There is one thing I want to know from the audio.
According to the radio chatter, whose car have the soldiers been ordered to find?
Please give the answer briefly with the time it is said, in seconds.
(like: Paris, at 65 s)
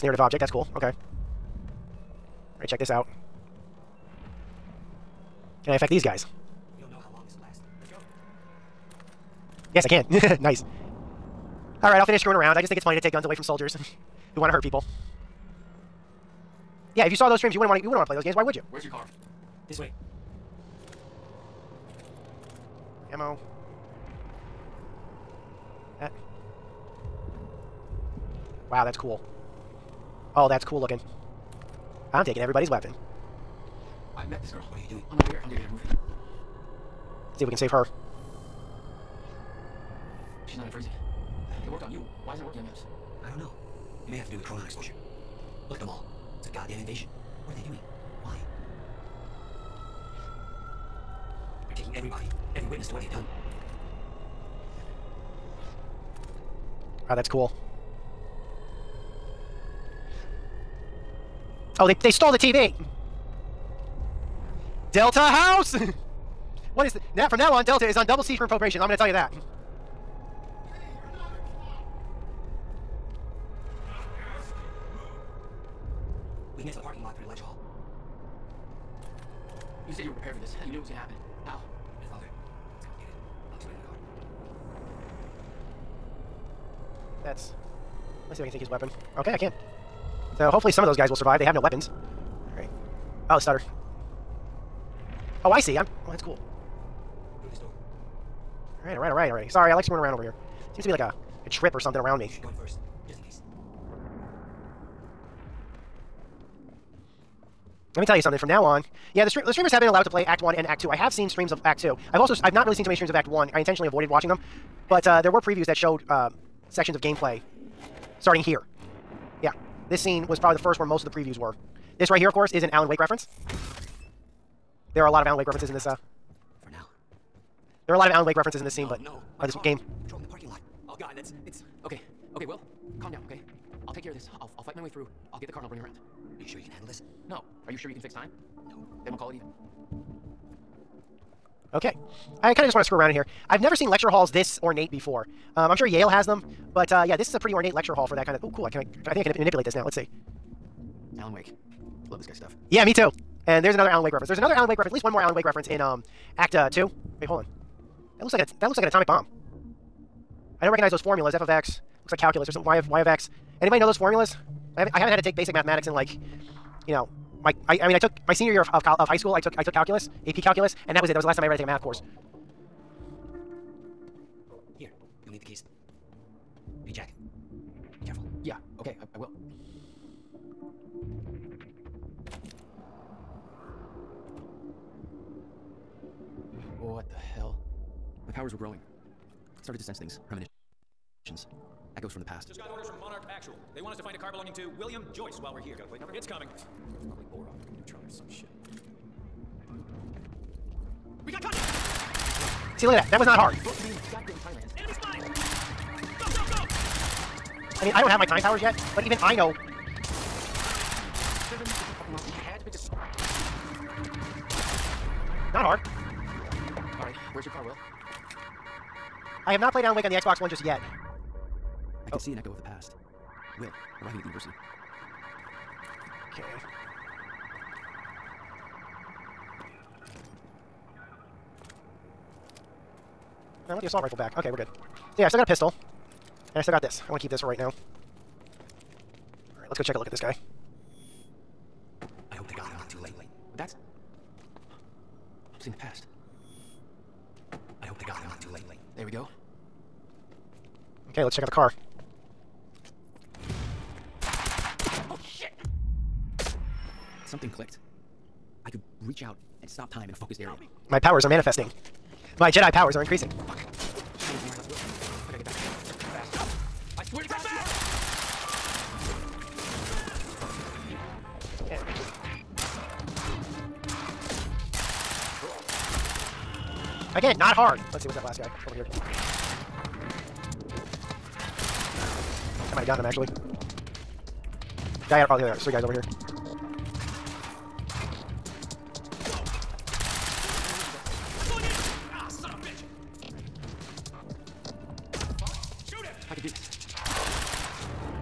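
William Joyce, at 194 s.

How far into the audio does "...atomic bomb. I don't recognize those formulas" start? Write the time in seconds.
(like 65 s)
158 s.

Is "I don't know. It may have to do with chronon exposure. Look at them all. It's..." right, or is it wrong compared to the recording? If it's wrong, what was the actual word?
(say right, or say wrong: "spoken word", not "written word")
right.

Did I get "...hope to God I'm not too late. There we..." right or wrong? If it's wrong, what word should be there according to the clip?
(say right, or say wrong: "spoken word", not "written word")
right.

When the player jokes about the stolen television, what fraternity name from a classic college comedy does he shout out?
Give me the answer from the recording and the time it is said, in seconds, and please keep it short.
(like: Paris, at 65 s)
Delta House, at 64 s.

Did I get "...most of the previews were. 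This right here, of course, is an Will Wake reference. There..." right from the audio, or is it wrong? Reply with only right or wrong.
wrong.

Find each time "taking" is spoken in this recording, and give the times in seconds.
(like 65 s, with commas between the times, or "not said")
32 s, 51 s.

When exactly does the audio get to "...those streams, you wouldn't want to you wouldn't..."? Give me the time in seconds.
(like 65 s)
17 s.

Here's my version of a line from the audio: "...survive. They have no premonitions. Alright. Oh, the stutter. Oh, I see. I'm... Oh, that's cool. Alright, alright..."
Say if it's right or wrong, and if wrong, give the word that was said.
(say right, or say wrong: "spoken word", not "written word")
wrong: "weapons", not "premonitions".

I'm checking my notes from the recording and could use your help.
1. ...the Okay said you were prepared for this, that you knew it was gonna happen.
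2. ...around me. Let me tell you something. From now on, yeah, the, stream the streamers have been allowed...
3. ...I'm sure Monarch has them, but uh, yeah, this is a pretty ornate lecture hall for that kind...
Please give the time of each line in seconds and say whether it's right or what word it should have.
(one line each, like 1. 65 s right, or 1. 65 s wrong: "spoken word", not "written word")
1. 76 s wrong: "You", not "Okay"
2. 101 s right
3. 145 s wrong: "Yale", not "Monarch".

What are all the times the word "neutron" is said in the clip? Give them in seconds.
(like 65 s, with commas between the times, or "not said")
197 s.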